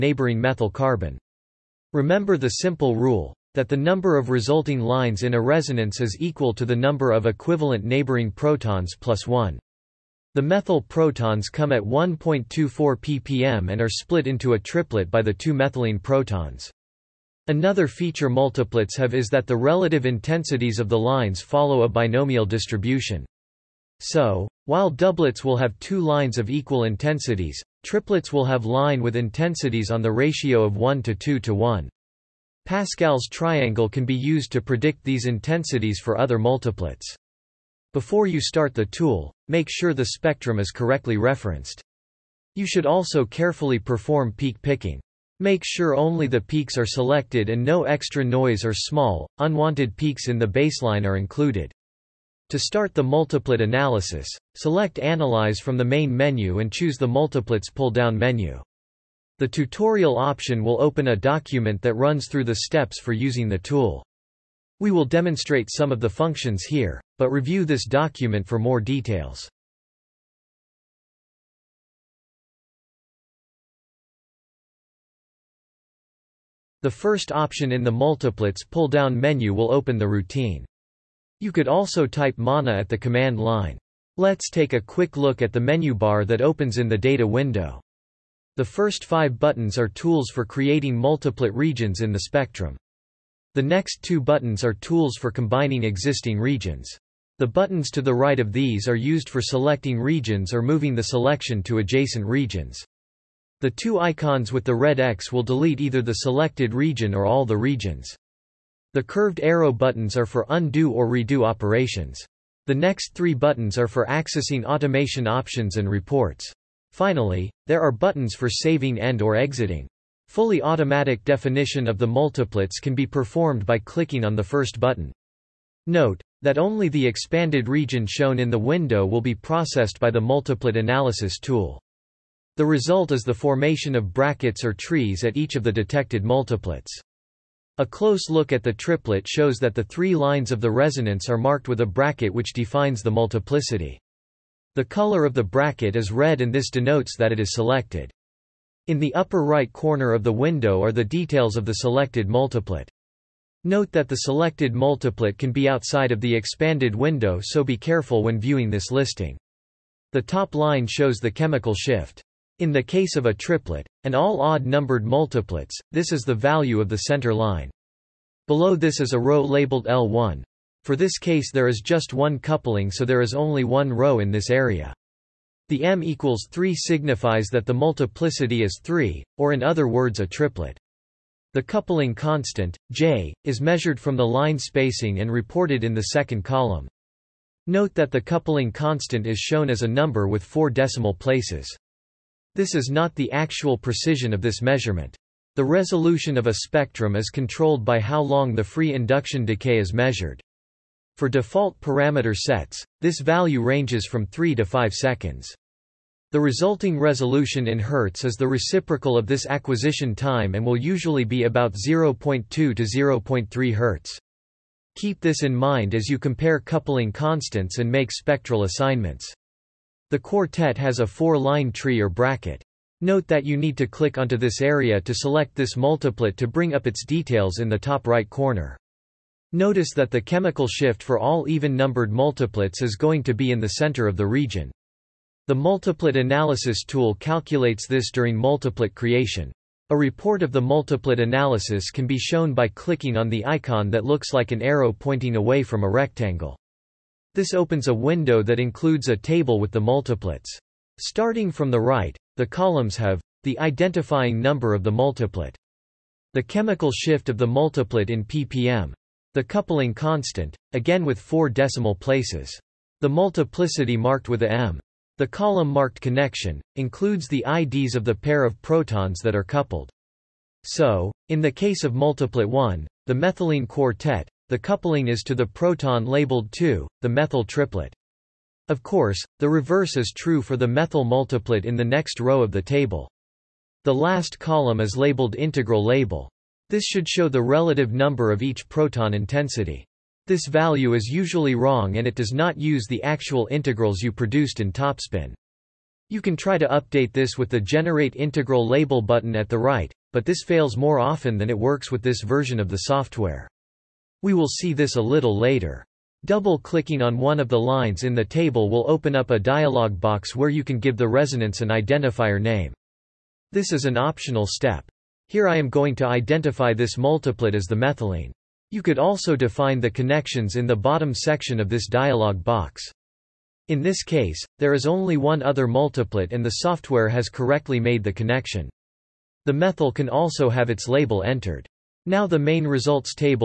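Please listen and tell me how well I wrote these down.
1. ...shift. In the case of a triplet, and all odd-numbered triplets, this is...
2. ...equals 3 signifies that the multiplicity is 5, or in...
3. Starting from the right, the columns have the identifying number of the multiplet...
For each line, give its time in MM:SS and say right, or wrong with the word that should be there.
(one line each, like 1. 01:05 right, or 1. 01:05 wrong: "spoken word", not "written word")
1. 02:41 wrong: "multiplets", not "triplets"
2. 02:56 wrong: "3", not "5"
3. 04:11 right.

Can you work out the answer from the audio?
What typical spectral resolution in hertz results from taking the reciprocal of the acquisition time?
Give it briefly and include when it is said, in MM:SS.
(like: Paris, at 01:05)
0.2 to 0.3 Hz, at 03:31.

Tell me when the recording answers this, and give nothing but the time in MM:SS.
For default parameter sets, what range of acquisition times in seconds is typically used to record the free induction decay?
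03:24.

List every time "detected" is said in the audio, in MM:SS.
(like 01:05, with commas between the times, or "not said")
02:15.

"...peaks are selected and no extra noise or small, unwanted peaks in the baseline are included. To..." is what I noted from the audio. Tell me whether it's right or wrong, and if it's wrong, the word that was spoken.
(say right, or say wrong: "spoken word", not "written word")
right.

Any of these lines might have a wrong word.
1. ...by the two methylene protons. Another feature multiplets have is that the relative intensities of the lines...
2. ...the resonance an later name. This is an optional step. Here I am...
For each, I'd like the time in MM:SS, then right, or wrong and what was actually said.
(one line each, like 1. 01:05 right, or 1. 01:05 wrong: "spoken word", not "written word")
1. 00:15 right
2. 05:10 wrong: "identifier", not "later".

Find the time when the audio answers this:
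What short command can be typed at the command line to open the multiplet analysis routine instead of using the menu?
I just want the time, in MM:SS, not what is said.
01:22.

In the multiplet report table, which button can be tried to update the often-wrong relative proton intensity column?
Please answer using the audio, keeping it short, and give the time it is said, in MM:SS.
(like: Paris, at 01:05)
Generate Integral Label, at 04:57.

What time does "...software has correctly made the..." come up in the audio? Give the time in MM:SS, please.
05:26.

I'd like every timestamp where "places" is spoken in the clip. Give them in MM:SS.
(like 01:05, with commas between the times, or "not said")
03:11, 04:21.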